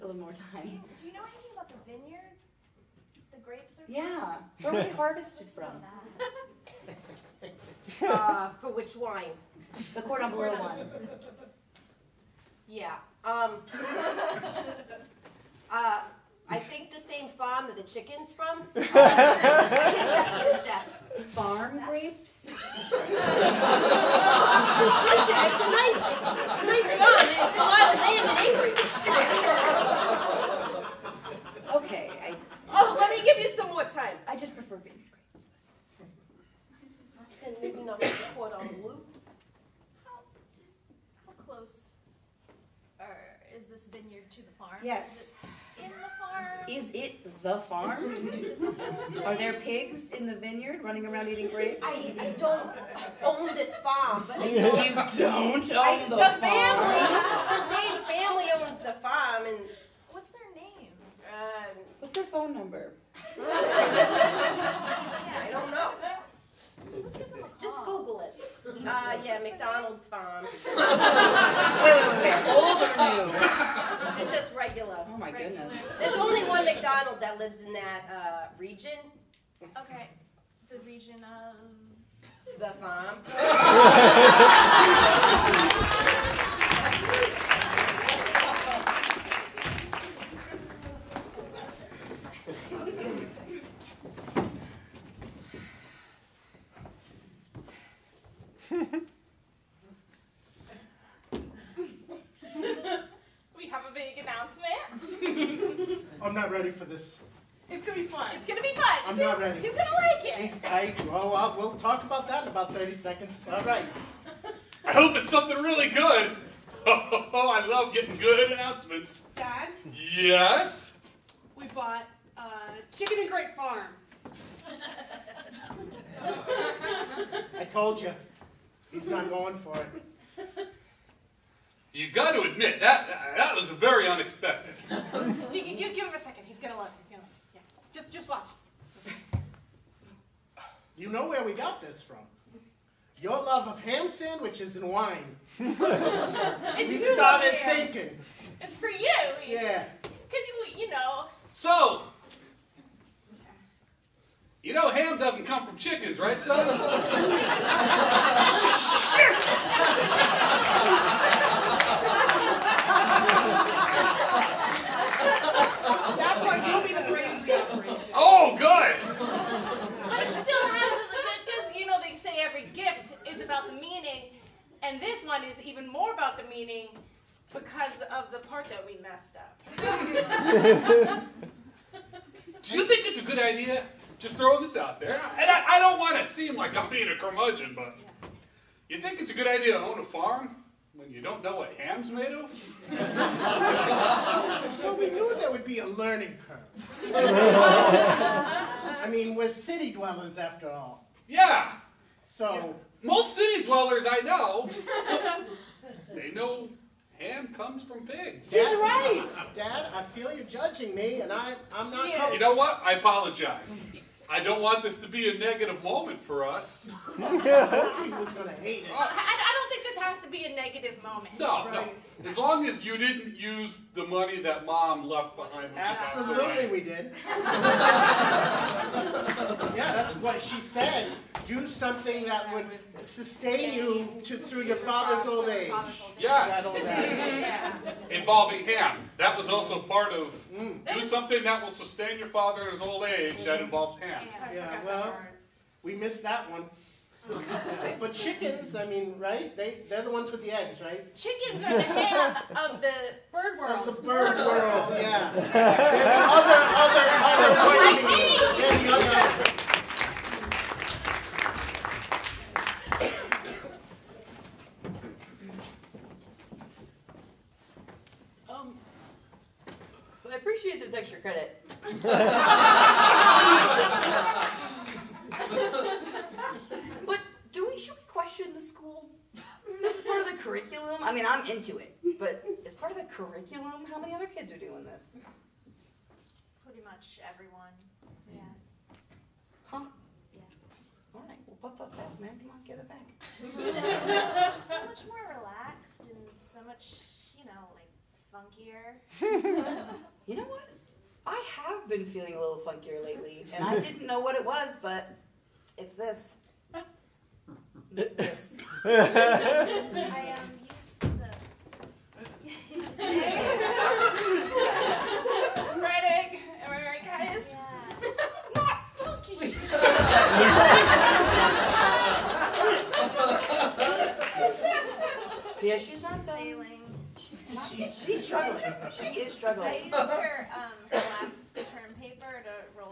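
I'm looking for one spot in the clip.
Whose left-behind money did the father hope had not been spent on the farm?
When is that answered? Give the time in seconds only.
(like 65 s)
224 s.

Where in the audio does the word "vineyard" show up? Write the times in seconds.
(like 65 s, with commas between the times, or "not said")
1 s, 50 s.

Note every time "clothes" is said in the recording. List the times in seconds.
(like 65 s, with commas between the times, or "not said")
not said.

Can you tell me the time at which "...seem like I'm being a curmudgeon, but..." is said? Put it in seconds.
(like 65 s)
186 s.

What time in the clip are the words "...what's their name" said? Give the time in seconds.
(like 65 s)
60 s.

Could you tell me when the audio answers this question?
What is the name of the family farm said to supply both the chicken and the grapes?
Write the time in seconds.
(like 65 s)
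69 s.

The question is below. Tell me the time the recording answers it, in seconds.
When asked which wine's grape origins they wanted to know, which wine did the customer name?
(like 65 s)
9 s.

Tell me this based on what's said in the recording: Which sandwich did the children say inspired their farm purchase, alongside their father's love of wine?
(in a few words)
Ham sandwiches.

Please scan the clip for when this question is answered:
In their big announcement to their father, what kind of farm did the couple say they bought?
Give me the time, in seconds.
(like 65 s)
122 s.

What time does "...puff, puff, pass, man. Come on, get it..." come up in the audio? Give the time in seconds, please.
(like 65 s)
291 s.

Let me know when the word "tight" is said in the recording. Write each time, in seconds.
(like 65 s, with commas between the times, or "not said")
110 s.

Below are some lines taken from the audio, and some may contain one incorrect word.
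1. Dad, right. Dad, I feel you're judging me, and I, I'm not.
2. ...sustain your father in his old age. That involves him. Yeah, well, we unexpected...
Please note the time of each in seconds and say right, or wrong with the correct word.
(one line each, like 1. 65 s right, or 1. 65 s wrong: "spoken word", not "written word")
1. 208 s right
2. 241 s wrong: "missed", not "unexpected".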